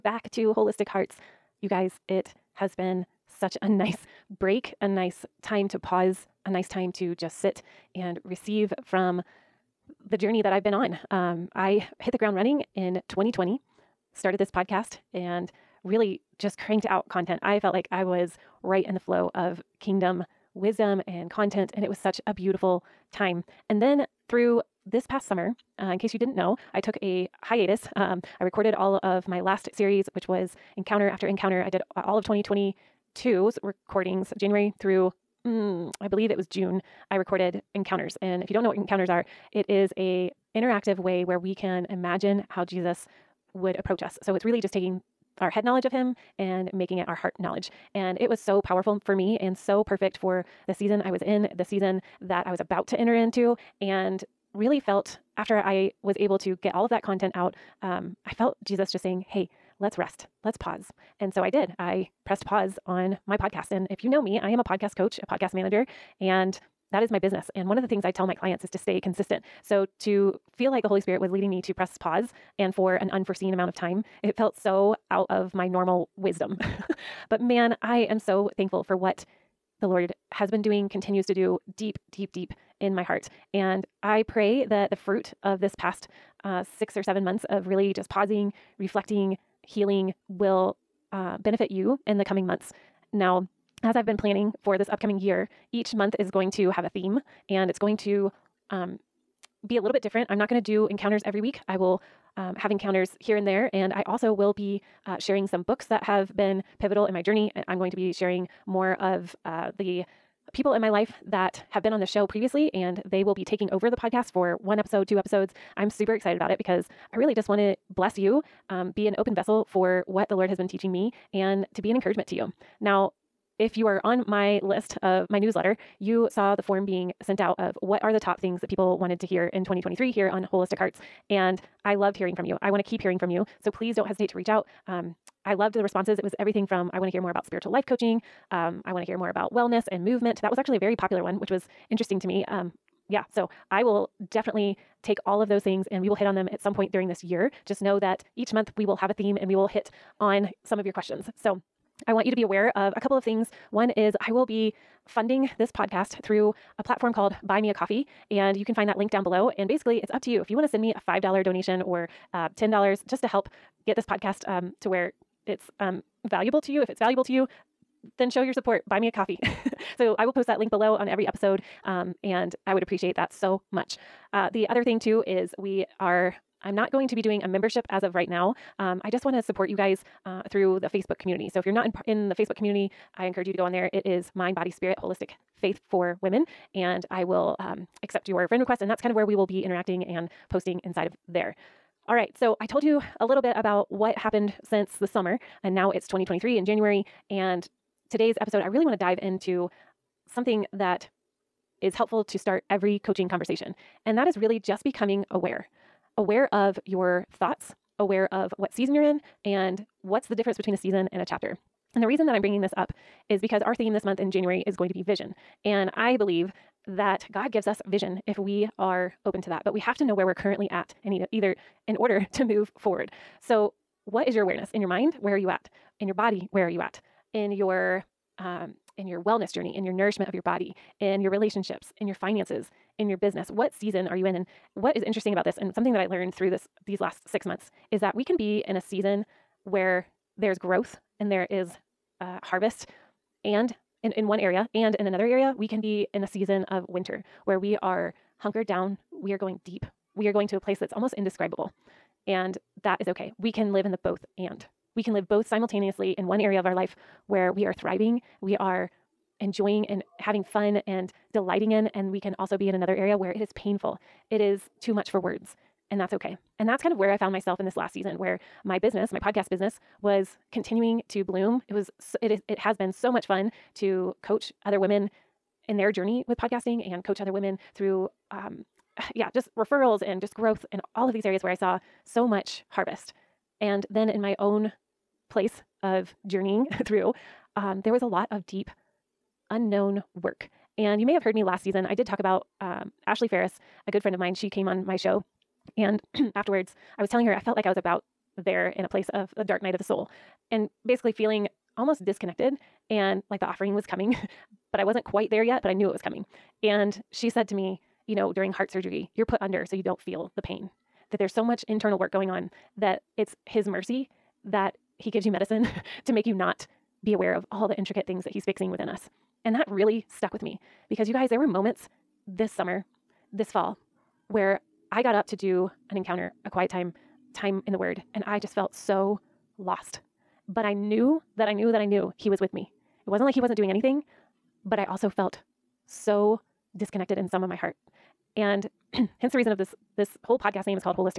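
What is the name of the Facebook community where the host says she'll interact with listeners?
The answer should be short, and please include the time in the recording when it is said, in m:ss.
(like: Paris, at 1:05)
Mind, Body, Spirit, Holistic Faith for Women, at 3:04.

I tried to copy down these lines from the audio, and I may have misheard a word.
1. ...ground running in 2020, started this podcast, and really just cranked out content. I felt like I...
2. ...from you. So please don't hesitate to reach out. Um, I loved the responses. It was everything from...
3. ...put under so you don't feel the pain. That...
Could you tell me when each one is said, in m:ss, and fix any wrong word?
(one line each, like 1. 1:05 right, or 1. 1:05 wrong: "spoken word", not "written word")
1. 0:12 right
2. 2:13 right
3. 5:09 right.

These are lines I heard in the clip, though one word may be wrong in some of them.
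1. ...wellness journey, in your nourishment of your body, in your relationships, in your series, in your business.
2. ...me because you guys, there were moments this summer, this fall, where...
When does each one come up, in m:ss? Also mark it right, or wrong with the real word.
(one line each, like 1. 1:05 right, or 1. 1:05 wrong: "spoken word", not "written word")
1. 3:49 wrong: "finances", not "series"
2. 5:20 right.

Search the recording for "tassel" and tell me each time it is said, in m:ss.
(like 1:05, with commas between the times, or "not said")
not said.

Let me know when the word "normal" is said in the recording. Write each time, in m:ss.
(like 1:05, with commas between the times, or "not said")
1:15.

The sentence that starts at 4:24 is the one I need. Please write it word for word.
It is too much for words, and that's okay.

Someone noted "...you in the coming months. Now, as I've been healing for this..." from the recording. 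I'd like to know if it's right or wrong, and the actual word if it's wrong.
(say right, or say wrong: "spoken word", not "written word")
wrong: "planning", not "healing".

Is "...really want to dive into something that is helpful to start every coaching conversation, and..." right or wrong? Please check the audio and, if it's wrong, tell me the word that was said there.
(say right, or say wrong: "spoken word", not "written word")
right.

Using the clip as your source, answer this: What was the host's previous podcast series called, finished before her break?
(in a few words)
Encounter After Encounter.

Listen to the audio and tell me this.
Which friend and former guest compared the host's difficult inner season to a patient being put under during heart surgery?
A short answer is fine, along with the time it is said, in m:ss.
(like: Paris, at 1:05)
Ashley Ferris, at 4:53.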